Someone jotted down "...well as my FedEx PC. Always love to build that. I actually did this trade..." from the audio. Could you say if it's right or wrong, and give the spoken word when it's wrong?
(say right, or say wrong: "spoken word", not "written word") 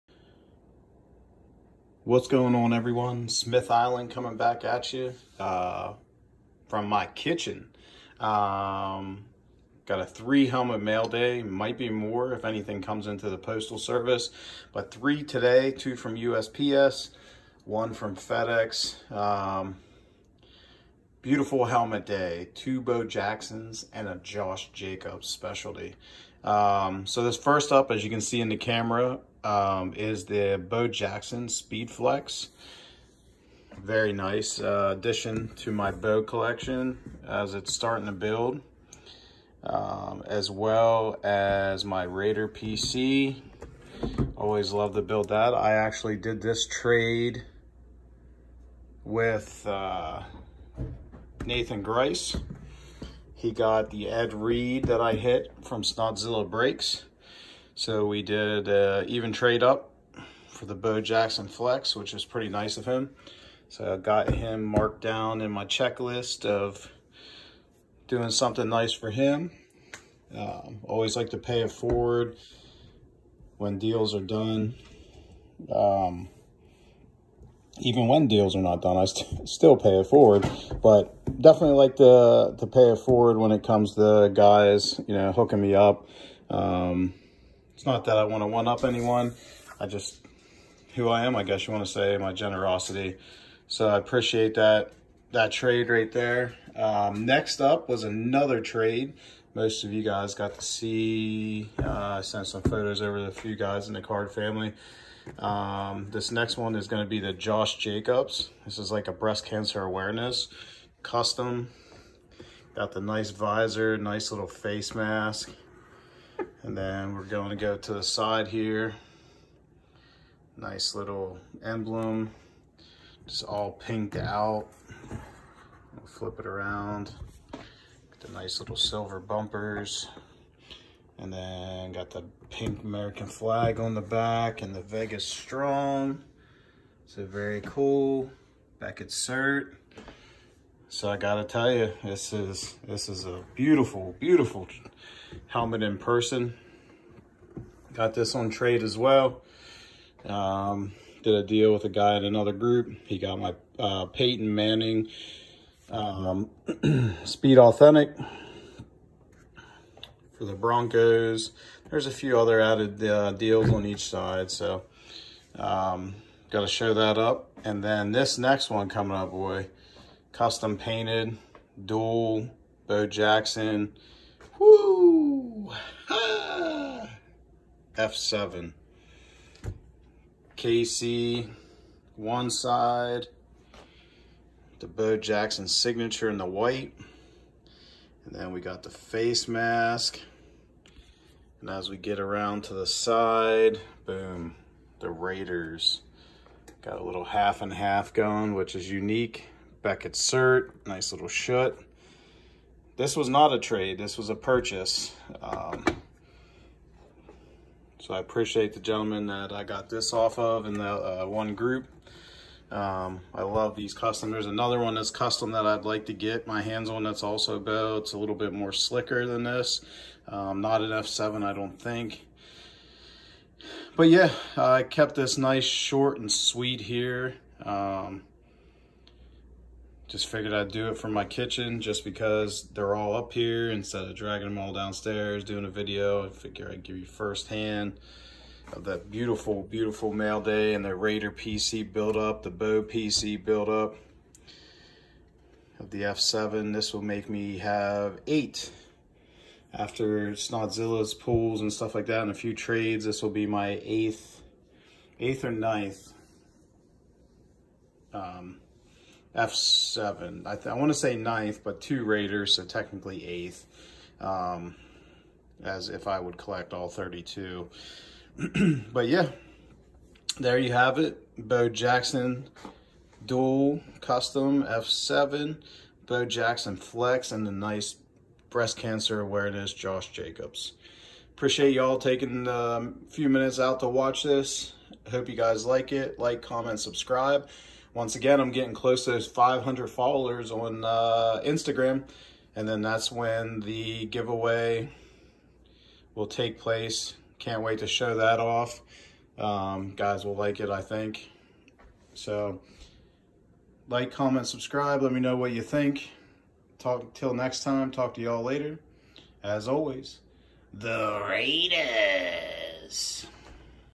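wrong: "Raider", not "FedEx".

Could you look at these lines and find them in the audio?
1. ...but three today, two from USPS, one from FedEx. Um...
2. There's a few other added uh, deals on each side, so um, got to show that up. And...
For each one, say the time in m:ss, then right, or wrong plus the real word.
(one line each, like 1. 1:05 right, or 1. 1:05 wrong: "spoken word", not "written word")
1. 0:14 right
2. 2:41 right.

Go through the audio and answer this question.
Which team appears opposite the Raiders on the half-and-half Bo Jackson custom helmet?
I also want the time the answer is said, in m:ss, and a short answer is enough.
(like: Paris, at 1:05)
KC, at 3:00.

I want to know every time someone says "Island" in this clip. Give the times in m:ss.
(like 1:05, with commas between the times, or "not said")
0:03.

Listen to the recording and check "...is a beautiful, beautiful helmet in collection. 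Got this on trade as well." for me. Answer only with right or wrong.
wrong.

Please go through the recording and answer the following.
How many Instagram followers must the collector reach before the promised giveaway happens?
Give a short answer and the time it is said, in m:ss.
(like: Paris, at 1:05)
500, at 4:49.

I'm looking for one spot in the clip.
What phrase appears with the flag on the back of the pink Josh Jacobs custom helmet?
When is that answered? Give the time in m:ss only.
2:14.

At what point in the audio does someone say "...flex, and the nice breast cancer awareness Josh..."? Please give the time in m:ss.
4:36.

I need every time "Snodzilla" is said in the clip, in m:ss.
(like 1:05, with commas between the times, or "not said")
0:55, 4:10.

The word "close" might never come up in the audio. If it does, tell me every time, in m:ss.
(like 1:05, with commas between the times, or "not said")
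4:48.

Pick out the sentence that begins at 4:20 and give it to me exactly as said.
I, I want to say ninth, but two Raiders, so technically eighth, um, as if I would collect all 32.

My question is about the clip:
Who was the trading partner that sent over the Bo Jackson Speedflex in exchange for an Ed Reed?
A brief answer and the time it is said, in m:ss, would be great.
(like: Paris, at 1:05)
Nathan Grice, at 0:51.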